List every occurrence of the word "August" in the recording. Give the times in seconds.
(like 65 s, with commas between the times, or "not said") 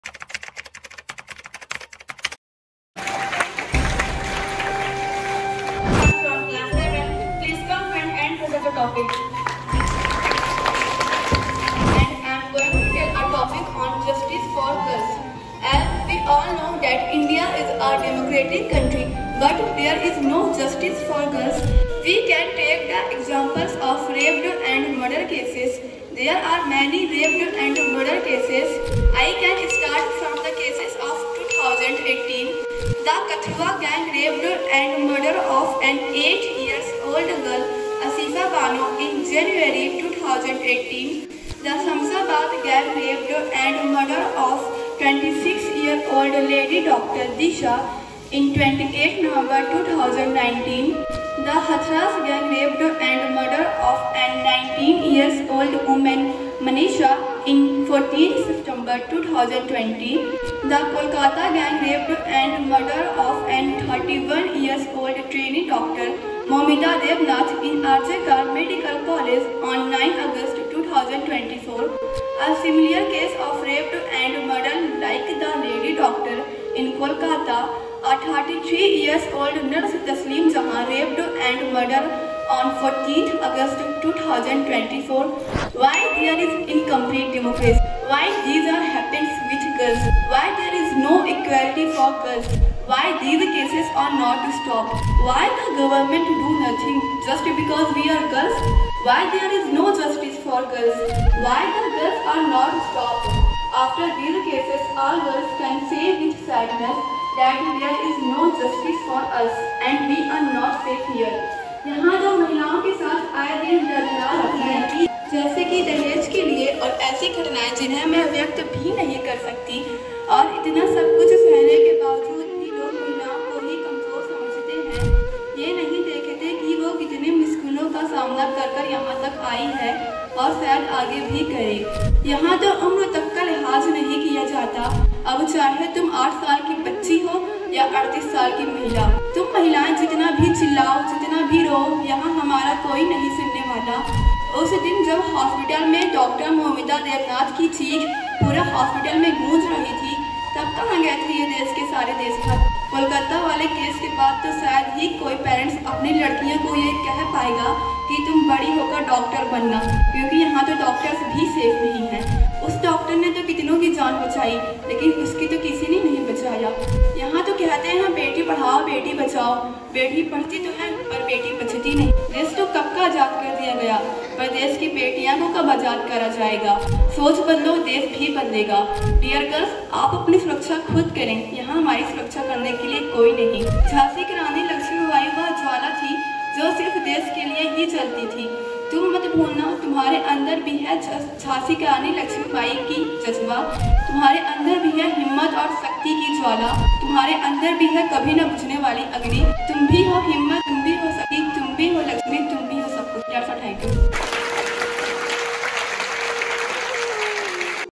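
70 s, 83 s.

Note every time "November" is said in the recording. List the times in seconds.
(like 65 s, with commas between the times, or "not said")
49 s.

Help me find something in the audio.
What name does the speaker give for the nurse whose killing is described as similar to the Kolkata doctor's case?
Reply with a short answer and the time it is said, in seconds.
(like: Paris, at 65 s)
Taslim Jahan, at 80 s.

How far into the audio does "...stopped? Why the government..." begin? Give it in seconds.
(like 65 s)
94 s.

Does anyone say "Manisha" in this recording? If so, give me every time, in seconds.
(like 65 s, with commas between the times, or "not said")
56 s.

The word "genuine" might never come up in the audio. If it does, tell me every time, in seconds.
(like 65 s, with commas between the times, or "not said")
not said.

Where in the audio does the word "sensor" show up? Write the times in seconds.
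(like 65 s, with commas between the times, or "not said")
not said.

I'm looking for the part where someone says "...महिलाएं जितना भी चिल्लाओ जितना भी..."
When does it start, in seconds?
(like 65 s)
139 s.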